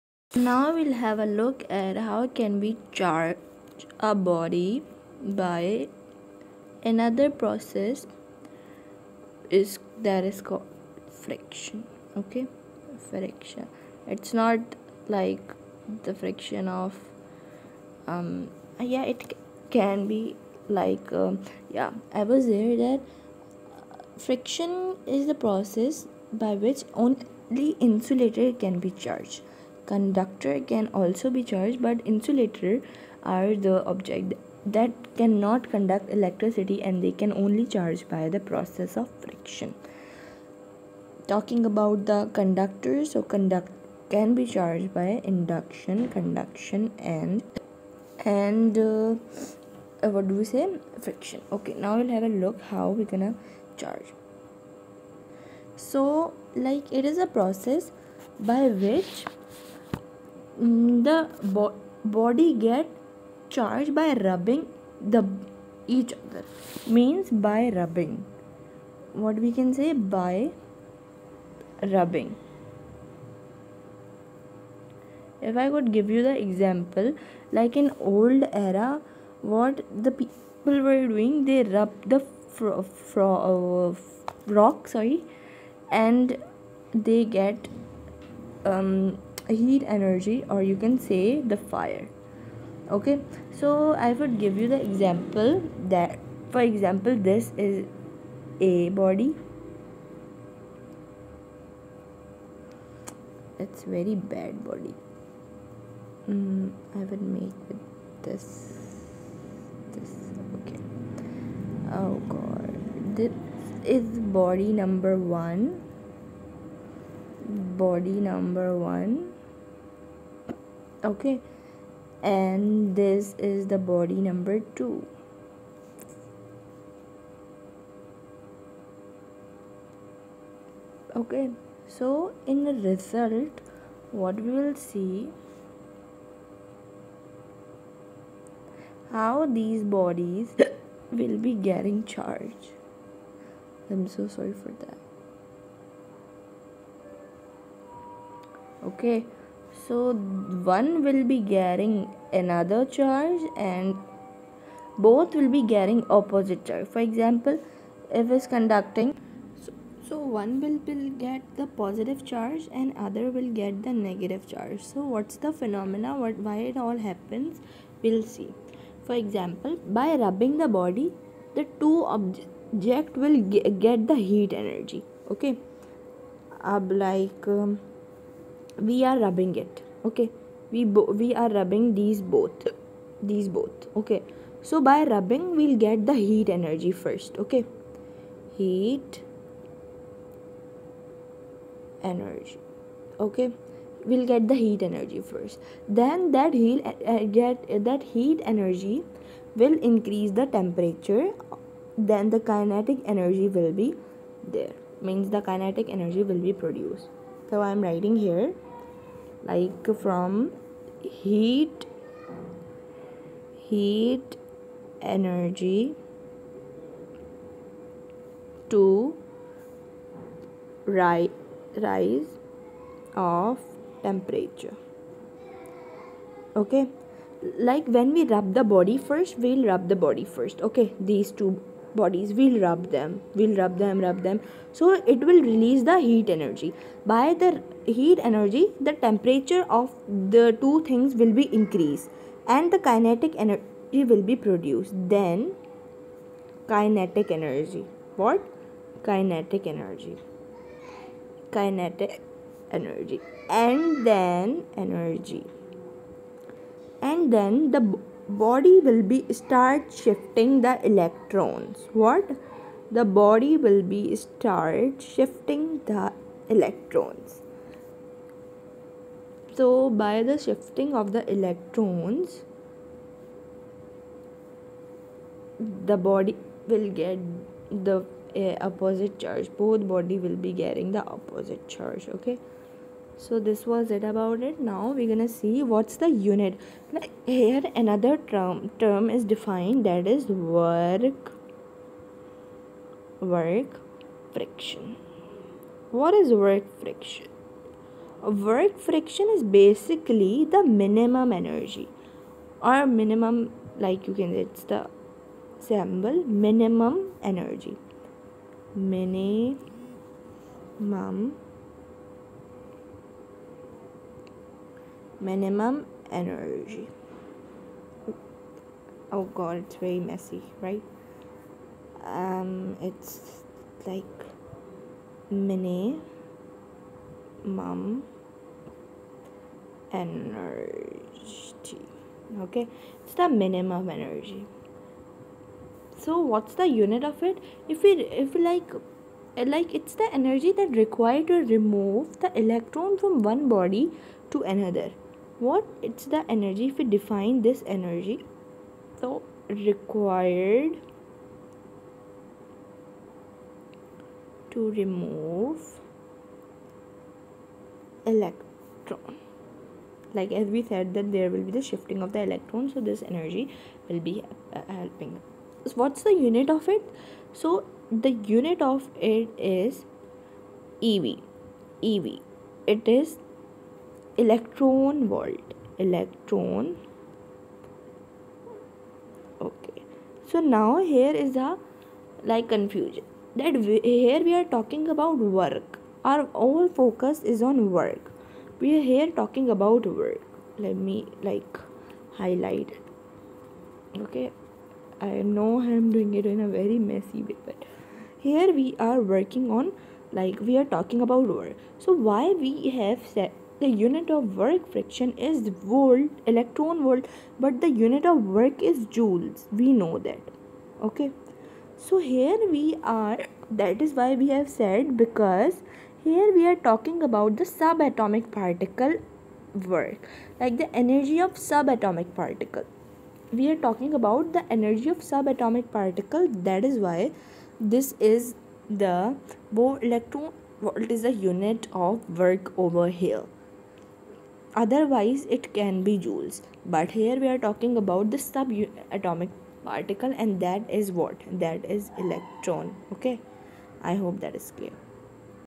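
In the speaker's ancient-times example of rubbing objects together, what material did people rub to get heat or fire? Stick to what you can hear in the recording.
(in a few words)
Rock.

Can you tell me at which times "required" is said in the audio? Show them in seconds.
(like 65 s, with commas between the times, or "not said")
340 s, 349 s.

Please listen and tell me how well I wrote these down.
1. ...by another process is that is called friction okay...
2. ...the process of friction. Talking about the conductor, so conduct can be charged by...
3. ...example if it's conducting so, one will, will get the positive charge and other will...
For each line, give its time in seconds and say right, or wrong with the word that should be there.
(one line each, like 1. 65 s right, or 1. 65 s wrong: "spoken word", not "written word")
1. 5 s right
2. 38 s right
3. 157 s right.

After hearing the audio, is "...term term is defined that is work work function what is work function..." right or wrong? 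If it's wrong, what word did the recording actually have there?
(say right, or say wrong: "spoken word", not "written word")
right.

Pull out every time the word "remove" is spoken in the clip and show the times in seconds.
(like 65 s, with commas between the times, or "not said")
341 s, 354 s.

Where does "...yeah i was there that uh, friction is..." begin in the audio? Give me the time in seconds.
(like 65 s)
21 s.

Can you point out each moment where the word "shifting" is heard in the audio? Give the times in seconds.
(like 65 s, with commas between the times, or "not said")
259 s, 265 s, 270 s, 361 s.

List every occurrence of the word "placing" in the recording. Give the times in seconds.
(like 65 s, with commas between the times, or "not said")
not said.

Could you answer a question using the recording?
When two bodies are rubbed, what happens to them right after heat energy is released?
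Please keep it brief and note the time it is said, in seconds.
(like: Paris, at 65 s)
Rise of temperature, at 221 s.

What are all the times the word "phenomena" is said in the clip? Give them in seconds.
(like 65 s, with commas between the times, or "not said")
165 s.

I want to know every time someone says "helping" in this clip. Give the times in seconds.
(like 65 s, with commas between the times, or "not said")
364 s.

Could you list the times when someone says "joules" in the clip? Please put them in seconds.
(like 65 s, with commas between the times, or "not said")
408 s, 435 s.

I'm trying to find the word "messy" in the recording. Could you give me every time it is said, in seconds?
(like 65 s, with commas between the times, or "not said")
319 s, 396 s.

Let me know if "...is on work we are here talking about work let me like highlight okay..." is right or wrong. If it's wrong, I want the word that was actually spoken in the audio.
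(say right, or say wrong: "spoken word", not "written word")
right.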